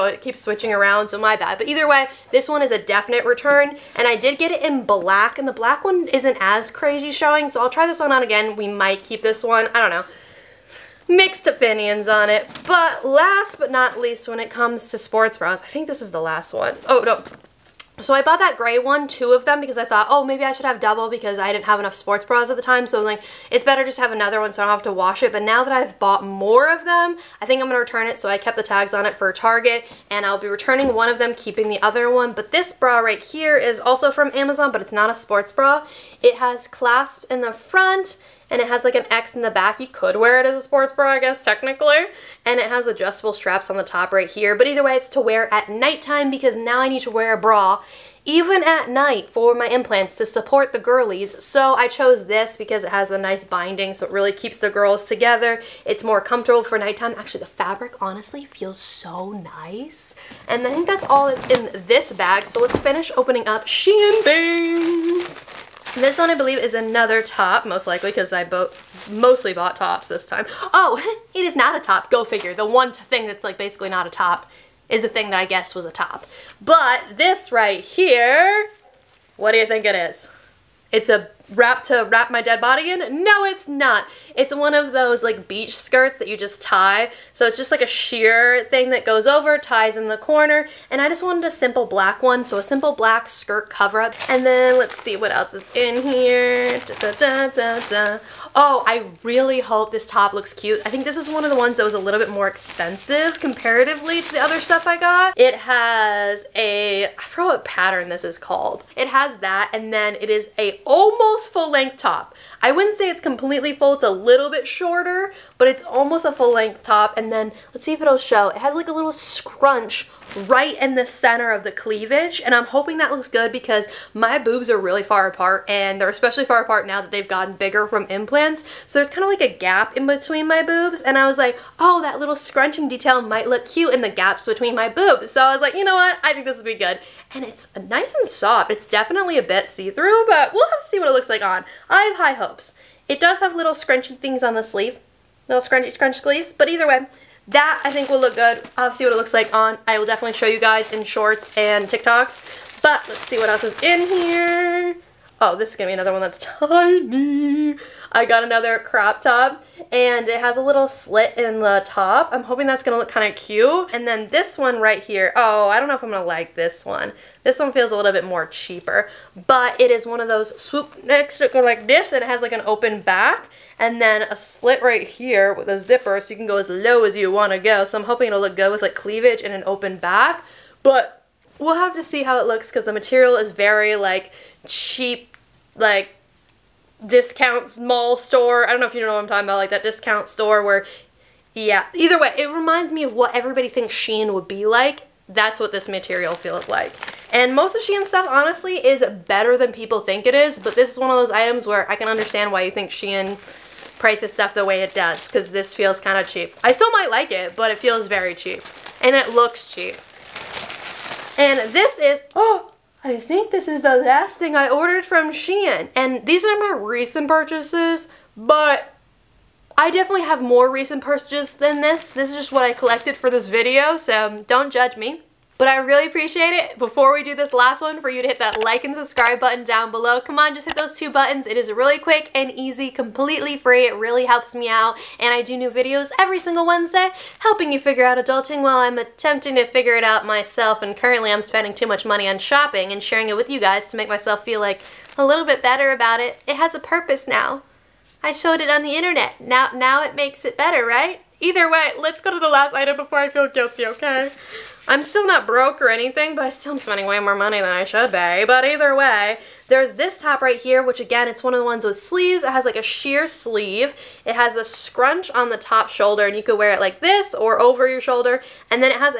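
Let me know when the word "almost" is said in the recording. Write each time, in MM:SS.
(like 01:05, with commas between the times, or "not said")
01:50, 01:55.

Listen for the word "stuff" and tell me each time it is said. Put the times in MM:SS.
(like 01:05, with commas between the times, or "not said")
01:44, 03:18, 03:24.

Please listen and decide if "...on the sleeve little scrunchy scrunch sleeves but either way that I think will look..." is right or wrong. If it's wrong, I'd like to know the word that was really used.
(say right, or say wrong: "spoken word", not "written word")
right.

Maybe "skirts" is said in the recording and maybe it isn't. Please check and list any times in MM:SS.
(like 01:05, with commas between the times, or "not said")
01:25, 01:33.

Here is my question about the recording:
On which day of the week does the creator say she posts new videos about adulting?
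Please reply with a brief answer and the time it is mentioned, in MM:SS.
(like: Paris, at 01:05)
Wednesday, at 03:56.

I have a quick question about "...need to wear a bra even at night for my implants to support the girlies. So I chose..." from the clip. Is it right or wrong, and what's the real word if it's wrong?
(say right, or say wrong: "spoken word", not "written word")
right.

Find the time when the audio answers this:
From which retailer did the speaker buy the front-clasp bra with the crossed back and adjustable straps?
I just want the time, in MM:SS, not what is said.
00:34.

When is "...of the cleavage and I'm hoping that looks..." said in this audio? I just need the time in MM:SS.
02:01.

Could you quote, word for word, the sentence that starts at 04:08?
I showed it on the internet.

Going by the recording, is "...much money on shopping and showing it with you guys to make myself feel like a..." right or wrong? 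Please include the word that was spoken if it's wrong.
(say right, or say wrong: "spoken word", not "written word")
wrong: "sharing", not "showing".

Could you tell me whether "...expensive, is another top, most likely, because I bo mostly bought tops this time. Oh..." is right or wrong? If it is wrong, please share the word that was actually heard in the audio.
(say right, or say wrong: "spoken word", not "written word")
wrong: "believe", not "expensive".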